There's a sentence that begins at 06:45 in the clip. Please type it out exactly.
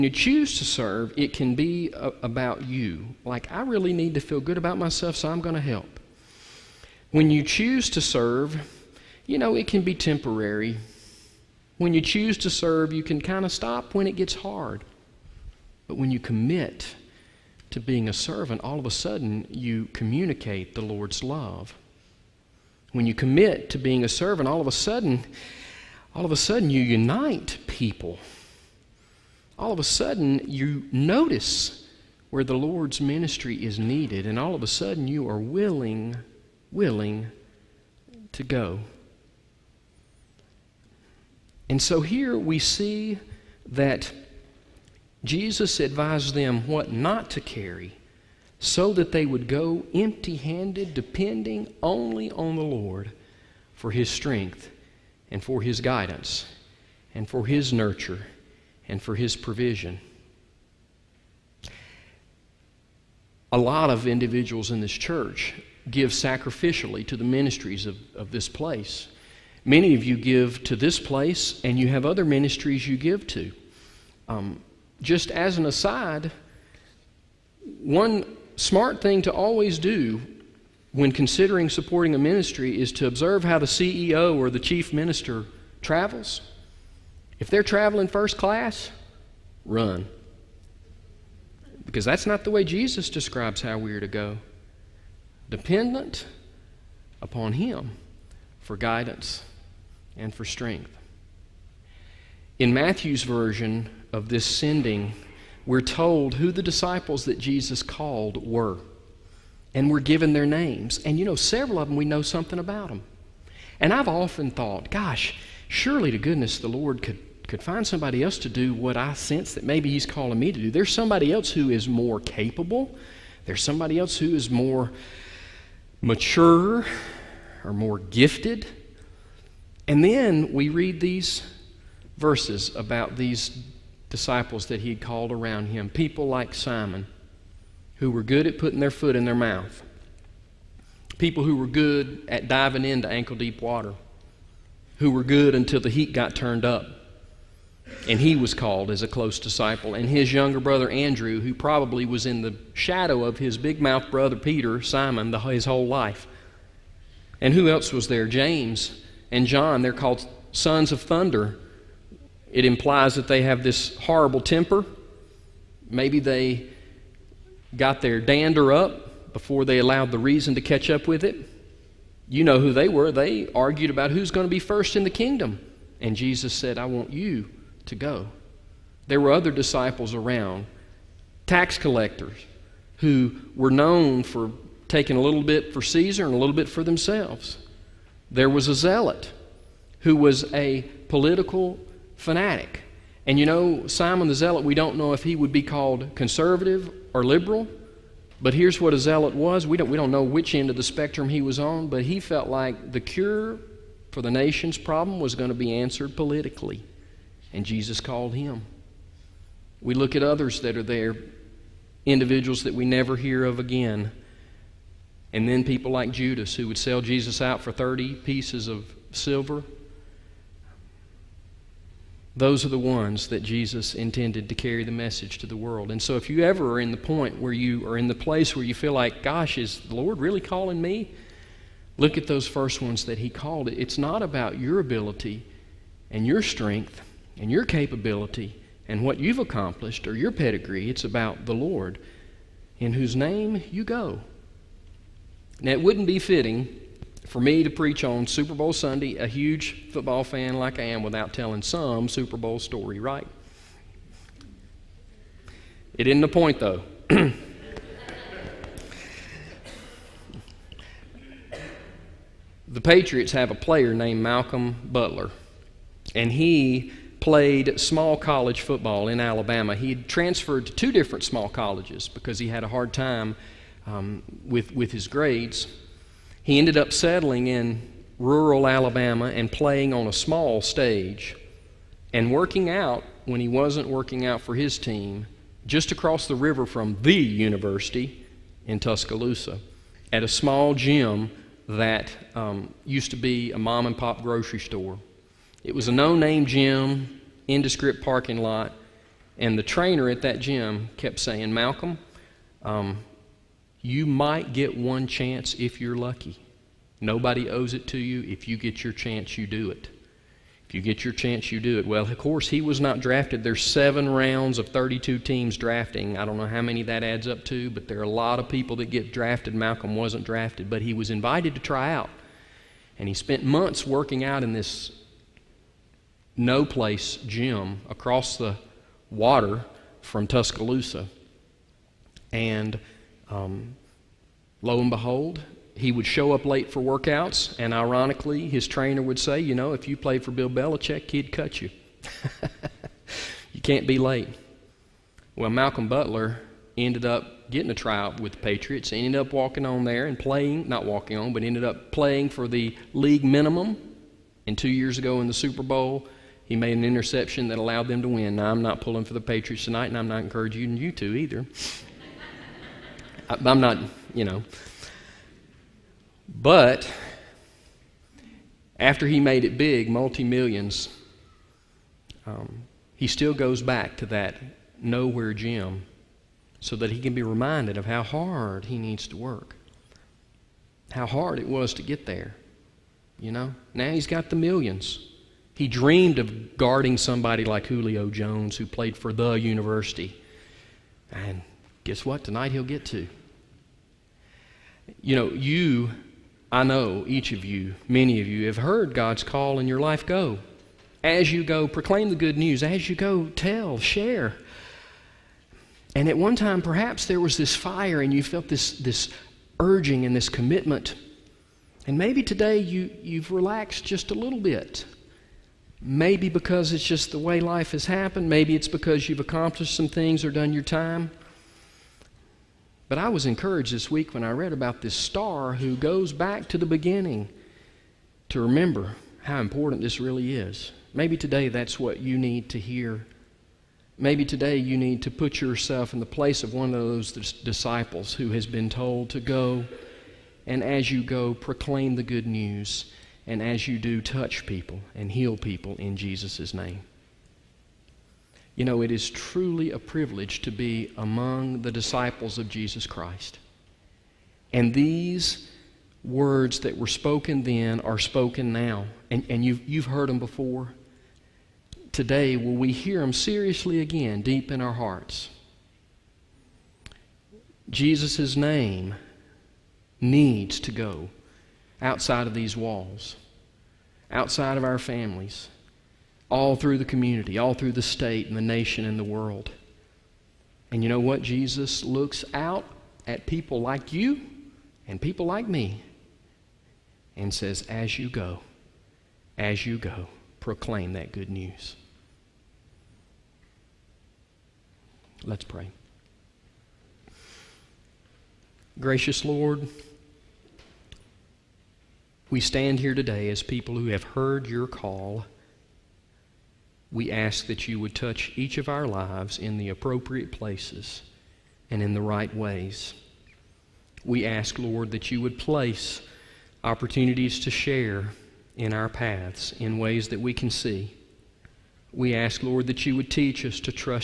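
And at one time, perhaps there was this fire and you felt this, this urging and this commitment.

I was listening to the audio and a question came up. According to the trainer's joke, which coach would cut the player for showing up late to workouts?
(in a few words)
Bill Belichick.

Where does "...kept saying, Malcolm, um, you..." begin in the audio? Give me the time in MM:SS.
05:00.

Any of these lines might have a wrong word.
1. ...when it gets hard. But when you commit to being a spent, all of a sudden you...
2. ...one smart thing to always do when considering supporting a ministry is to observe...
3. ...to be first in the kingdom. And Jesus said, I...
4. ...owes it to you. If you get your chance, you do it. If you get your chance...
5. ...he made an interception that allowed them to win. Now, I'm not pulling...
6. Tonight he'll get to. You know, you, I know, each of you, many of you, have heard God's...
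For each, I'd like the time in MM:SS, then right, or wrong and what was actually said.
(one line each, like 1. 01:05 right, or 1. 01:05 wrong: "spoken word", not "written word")
1. 00:13 wrong: "servant", not "spent"
2. 01:17 right
3. 02:54 right
4. 05:07 right
5. 05:56 right
6. 06:32 right.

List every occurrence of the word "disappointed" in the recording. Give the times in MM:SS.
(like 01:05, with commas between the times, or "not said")
not said.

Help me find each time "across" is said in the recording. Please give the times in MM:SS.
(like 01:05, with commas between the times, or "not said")
04:45, 05:27.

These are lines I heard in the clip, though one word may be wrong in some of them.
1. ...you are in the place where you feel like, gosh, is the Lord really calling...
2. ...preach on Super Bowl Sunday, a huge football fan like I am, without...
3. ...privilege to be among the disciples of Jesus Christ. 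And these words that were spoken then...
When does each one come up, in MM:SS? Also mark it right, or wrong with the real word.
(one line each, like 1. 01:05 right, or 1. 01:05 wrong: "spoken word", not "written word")
1. 03:47 right
2. 04:07 right
3. 07:29 right.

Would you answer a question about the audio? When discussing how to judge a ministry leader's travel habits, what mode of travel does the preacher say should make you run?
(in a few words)
first class.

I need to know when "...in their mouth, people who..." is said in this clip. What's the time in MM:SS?
02:19.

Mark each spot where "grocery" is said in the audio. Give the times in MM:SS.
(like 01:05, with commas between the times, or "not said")
04:54.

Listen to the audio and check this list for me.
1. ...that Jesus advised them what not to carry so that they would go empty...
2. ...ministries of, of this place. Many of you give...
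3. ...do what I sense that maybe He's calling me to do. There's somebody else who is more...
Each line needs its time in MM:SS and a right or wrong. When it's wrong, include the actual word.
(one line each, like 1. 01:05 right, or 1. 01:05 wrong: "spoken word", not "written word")
1. 00:43 right
2. 01:07 right
3. 01:58 right.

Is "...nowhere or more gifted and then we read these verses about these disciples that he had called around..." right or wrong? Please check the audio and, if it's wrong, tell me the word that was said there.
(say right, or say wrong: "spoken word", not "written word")
wrong: "mature", not "nowhere".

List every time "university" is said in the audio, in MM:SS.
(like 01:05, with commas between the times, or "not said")
04:47, 06:29.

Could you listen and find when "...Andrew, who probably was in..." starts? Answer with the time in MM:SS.
02:30.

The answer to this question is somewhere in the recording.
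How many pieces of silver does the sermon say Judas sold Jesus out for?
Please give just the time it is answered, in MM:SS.
03:37.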